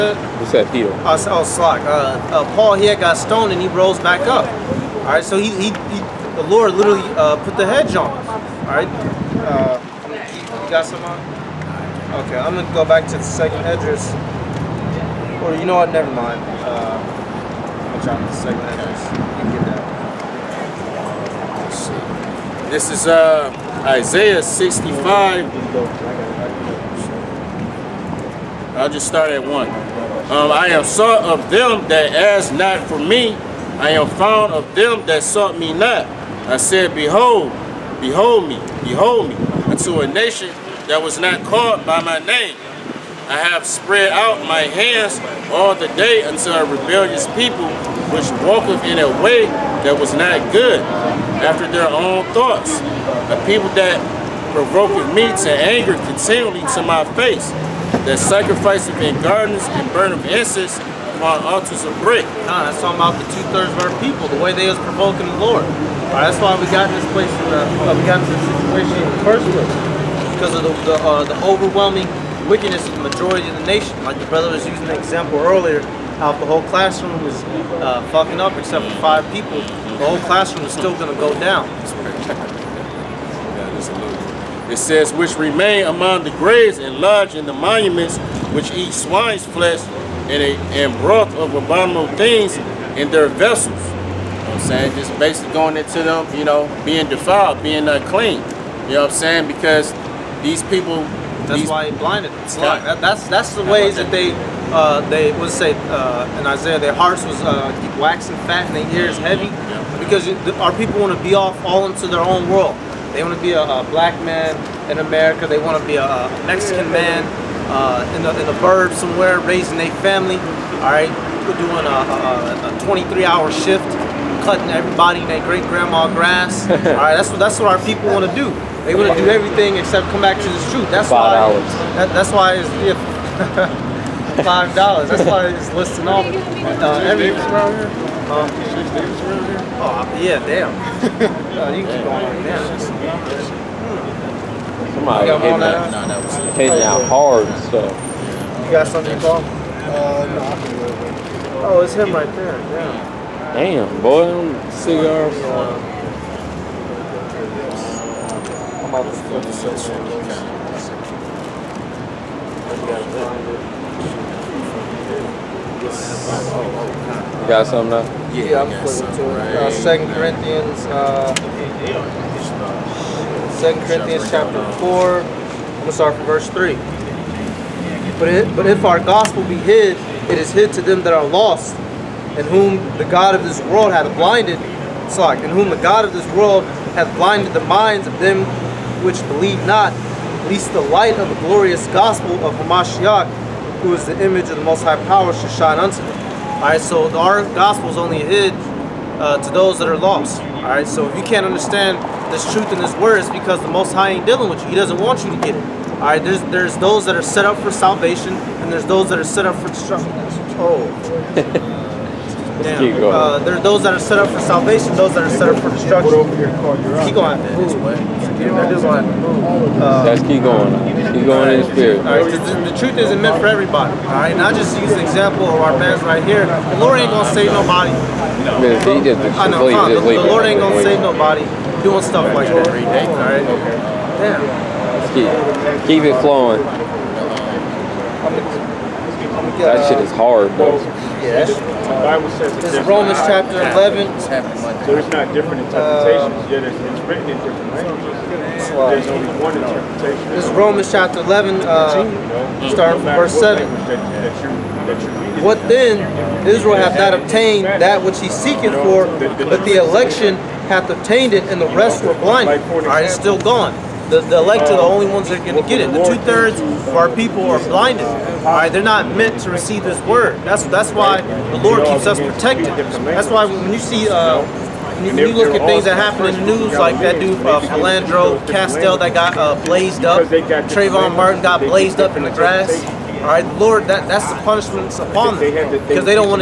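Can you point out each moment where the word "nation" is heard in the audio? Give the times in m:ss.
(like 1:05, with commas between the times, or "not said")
0:40, 1:13.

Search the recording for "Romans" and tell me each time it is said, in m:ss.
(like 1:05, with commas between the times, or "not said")
4:02, 4:10.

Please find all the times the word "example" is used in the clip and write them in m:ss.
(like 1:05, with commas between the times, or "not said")
1:14, 3:44.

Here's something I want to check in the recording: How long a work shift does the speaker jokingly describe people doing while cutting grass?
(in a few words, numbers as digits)
23 hours.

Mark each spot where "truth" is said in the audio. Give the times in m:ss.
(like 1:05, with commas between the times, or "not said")
2:10, 3:22, 3:42.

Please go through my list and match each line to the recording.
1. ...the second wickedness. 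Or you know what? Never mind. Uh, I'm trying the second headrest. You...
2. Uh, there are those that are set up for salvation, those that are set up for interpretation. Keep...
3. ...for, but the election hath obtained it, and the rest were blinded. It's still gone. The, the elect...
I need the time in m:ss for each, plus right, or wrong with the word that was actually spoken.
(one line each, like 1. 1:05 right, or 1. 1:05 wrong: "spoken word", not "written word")
1. 0:13 wrong: "address", not "wickedness"
2. 3:33 wrong: "destruction", not "interpretation"
3. 4:18 right.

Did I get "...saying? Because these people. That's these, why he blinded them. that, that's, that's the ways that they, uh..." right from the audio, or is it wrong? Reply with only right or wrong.
right.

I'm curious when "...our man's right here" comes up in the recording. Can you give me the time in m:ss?
3:45.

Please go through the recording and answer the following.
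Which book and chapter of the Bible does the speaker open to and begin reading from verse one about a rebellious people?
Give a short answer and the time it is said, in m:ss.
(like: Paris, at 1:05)
Isaiah 65, at 0:23.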